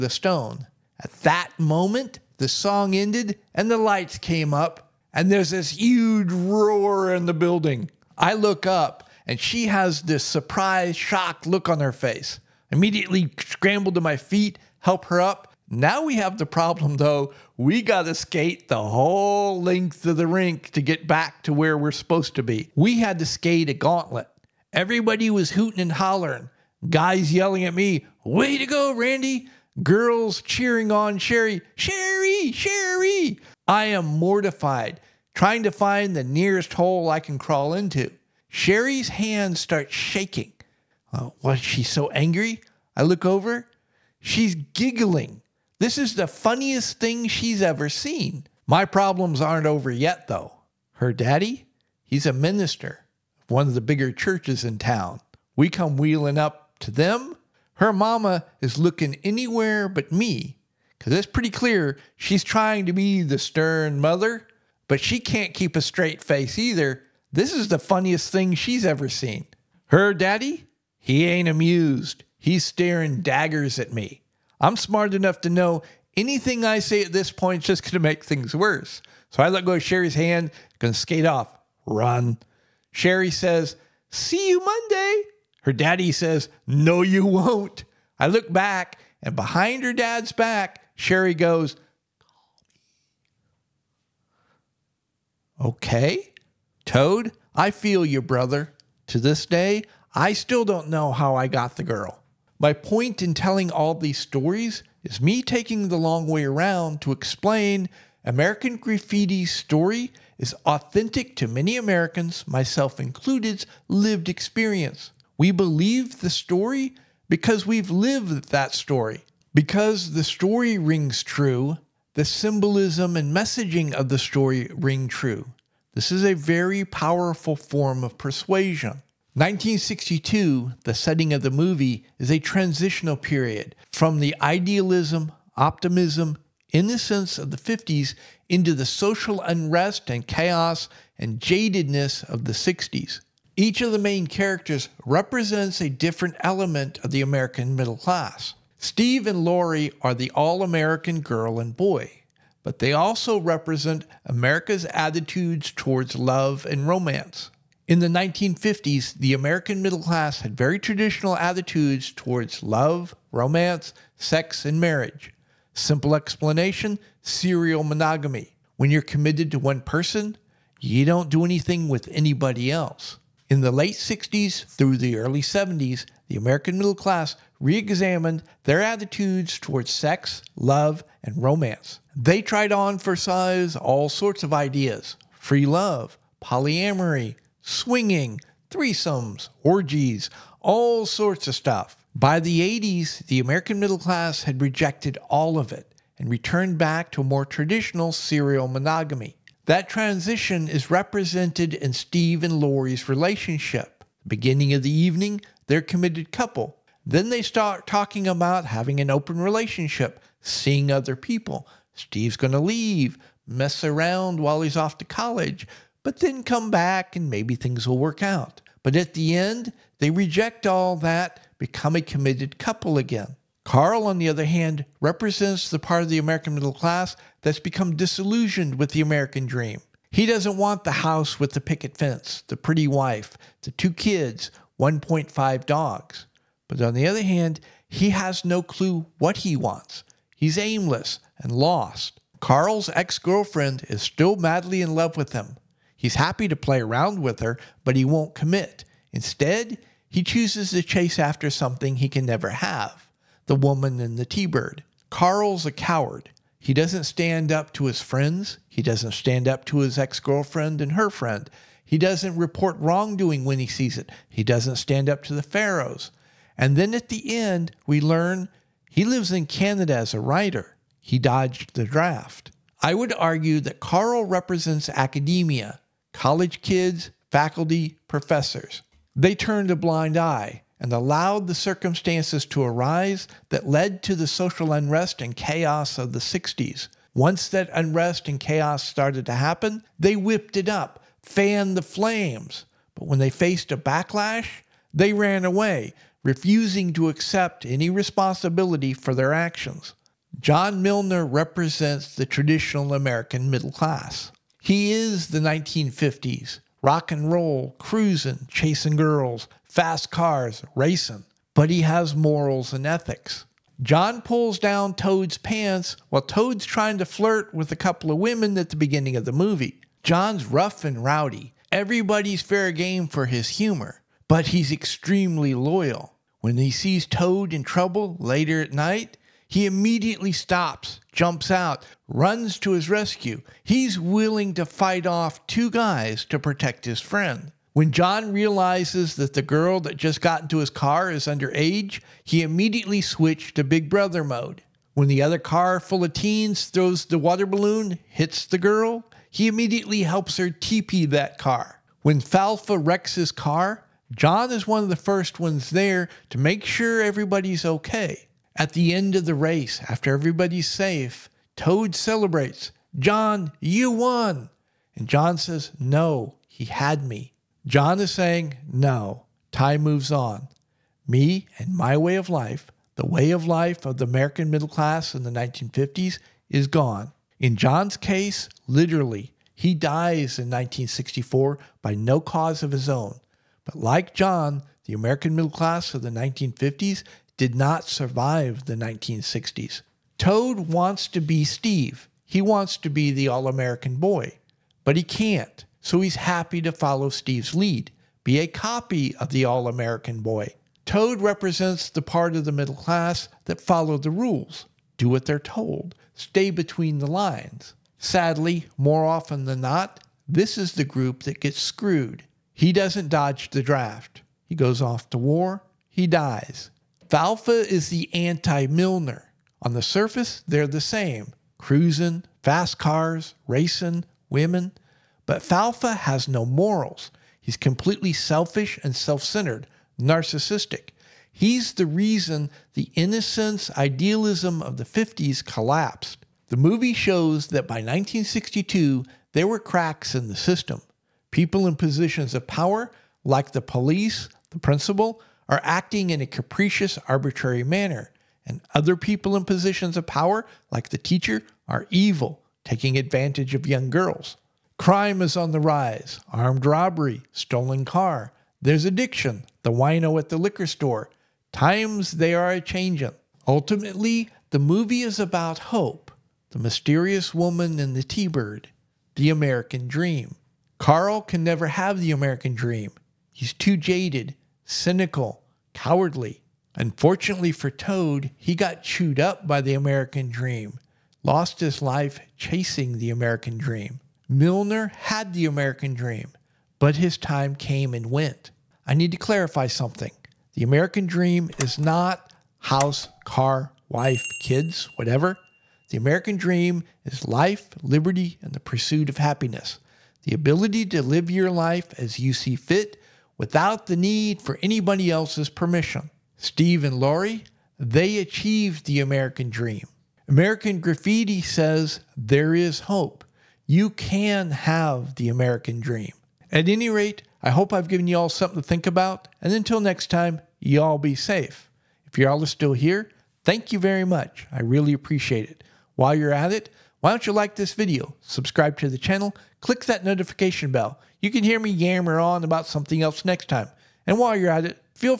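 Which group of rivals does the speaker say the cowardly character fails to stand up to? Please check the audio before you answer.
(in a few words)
The Pharaohs.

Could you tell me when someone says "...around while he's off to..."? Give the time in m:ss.
3:33.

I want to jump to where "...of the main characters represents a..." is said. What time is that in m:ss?
2:23.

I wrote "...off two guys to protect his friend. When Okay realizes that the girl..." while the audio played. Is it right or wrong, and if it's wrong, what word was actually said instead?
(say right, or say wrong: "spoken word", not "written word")
wrong: "John", not "Okay".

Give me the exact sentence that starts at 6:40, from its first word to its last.
Toad represents the part of the middle class that follow the rules, do what they're told, stay between the lines.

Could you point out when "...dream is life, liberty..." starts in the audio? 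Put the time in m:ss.
8:16.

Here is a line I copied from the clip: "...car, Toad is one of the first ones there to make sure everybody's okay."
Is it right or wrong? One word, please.
wrong.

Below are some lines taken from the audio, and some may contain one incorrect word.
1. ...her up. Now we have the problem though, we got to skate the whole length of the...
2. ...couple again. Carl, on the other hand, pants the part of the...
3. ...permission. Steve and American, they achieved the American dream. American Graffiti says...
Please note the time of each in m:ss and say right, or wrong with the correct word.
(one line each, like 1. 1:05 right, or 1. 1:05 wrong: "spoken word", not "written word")
1. 0:15 right
2. 3:42 wrong: "represents", not "pants"
3. 8:25 wrong: "Laurie", not "American".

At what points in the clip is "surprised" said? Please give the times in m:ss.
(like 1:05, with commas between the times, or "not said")
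0:10.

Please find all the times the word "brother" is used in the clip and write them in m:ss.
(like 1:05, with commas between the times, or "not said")
1:38, 5:43.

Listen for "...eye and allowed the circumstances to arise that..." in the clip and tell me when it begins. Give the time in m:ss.
4:40.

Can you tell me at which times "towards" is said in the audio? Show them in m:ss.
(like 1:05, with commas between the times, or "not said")
2:35, 2:42, 2:59.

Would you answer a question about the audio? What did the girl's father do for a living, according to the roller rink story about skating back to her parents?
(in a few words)
Minister.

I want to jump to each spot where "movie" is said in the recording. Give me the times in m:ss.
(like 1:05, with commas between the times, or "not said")
2:11, 5:19, 7:16, 7:44.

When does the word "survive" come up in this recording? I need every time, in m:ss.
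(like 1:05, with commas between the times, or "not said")
6:27.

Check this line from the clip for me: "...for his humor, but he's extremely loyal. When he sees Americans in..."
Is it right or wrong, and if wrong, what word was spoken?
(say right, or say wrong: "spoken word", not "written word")
wrong: "Toad", not "Americans".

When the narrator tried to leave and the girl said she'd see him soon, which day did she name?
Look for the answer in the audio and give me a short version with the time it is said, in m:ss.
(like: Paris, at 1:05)
Monday, at 1:24.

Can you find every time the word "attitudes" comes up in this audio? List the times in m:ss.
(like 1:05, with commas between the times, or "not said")
2:34, 2:41, 2:58.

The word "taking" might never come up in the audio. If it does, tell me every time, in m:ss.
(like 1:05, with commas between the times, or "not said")
1:45, 7:32.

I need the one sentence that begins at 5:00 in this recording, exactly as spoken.
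John Milner represents the traditional American middle class.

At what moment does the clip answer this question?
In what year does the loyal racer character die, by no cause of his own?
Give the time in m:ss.
6:20.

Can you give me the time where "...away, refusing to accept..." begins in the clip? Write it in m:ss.
4:55.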